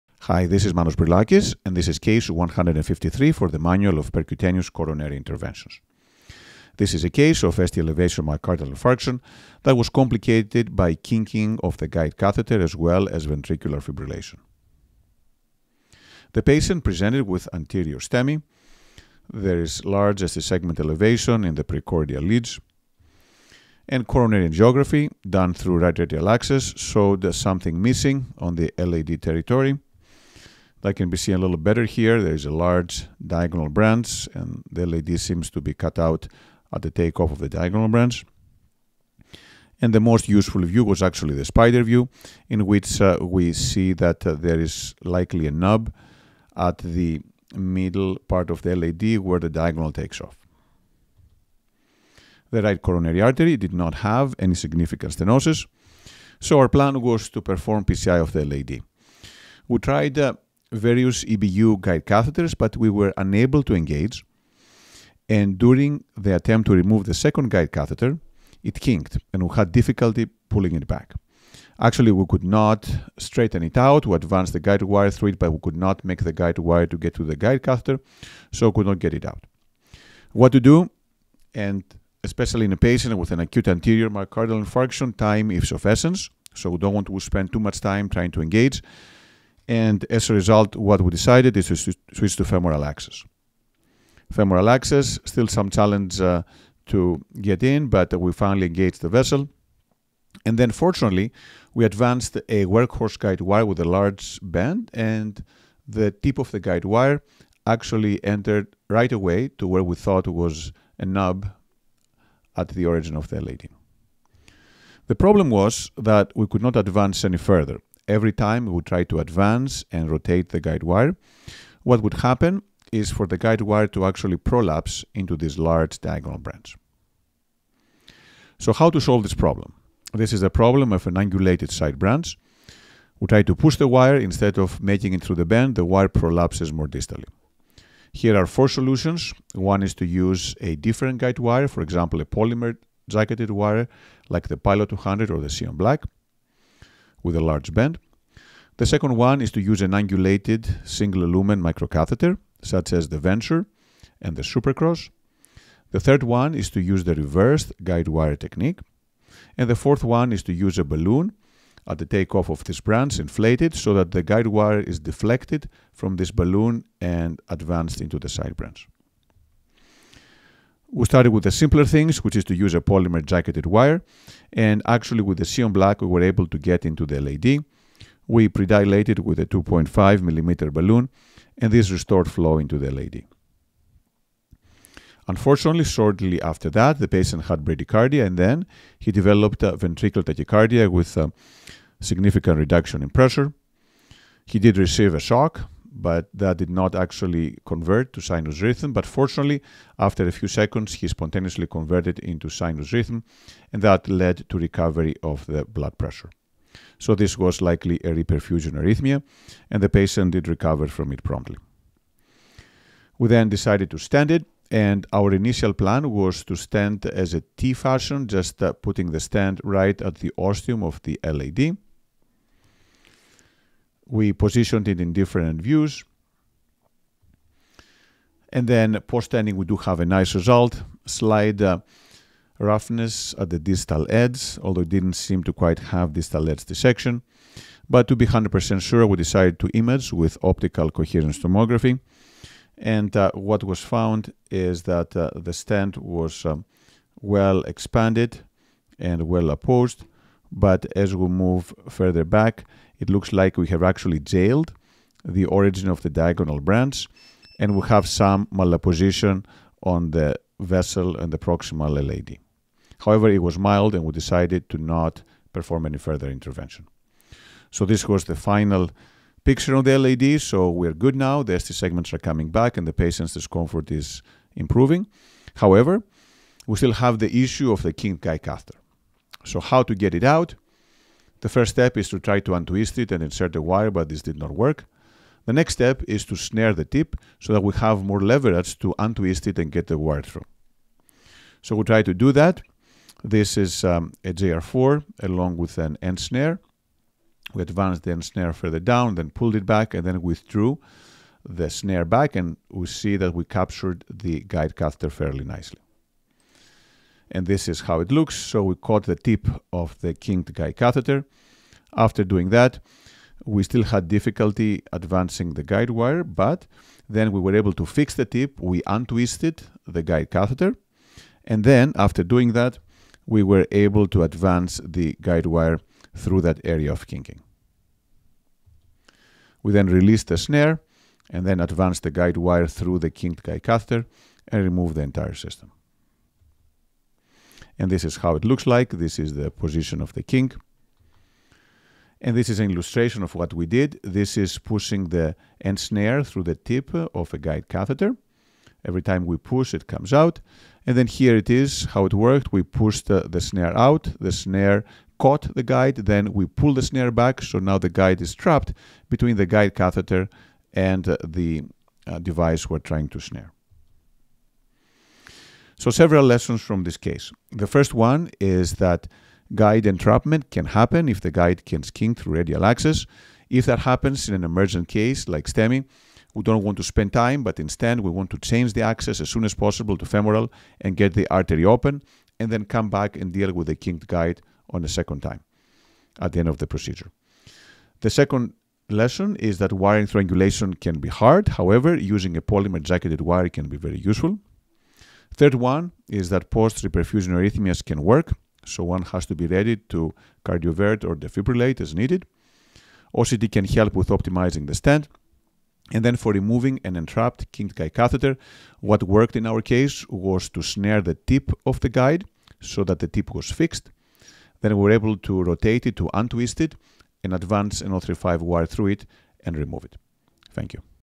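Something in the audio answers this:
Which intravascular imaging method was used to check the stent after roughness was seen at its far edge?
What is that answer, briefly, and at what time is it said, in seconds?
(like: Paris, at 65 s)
optical coherence tomography, at 240 s.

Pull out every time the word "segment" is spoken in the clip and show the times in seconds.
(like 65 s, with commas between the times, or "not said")
20 s, 271 s.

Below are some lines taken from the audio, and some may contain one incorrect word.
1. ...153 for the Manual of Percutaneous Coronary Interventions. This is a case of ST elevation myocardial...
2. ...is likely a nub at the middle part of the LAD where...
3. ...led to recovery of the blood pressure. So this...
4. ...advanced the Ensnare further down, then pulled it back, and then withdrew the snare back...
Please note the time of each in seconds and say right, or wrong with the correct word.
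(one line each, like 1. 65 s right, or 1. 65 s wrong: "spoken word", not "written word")
1. 2 s right
2. 44 s right
3. 204 s right
4. 297 s right.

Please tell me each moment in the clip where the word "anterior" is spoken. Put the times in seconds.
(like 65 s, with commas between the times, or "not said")
17 s, 83 s.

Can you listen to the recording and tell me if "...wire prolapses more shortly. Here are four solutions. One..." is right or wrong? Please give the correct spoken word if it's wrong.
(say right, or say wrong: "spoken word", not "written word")
wrong: "distally", not "shortly".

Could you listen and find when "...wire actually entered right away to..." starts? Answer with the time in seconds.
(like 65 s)
106 s.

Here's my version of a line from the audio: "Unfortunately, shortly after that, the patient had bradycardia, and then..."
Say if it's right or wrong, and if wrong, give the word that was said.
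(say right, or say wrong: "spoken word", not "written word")
right.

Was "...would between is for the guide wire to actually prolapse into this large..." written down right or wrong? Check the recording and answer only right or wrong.
wrong.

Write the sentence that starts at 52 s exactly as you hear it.
The right coronary artery did not have any significant stenosis, so our plan was to perform PCI of the LAD.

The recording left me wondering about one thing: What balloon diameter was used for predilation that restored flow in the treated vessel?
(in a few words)
2.5 mm.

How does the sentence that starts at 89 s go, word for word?
And as a result, what we decided is to switch to femoral access.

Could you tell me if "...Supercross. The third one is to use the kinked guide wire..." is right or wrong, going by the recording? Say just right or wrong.
wrong.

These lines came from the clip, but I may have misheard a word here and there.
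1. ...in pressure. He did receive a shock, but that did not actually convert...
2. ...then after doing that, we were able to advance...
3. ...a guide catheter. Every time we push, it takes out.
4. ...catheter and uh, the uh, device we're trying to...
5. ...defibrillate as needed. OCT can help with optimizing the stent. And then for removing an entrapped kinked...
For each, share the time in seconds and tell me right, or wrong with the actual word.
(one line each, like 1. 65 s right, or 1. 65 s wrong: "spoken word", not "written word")
1. 193 s right
2. 321 s right
3. 347 s wrong: "comes", not "takes"
4. 359 s right
5. 401 s right.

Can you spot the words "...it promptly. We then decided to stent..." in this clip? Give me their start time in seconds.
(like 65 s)
211 s.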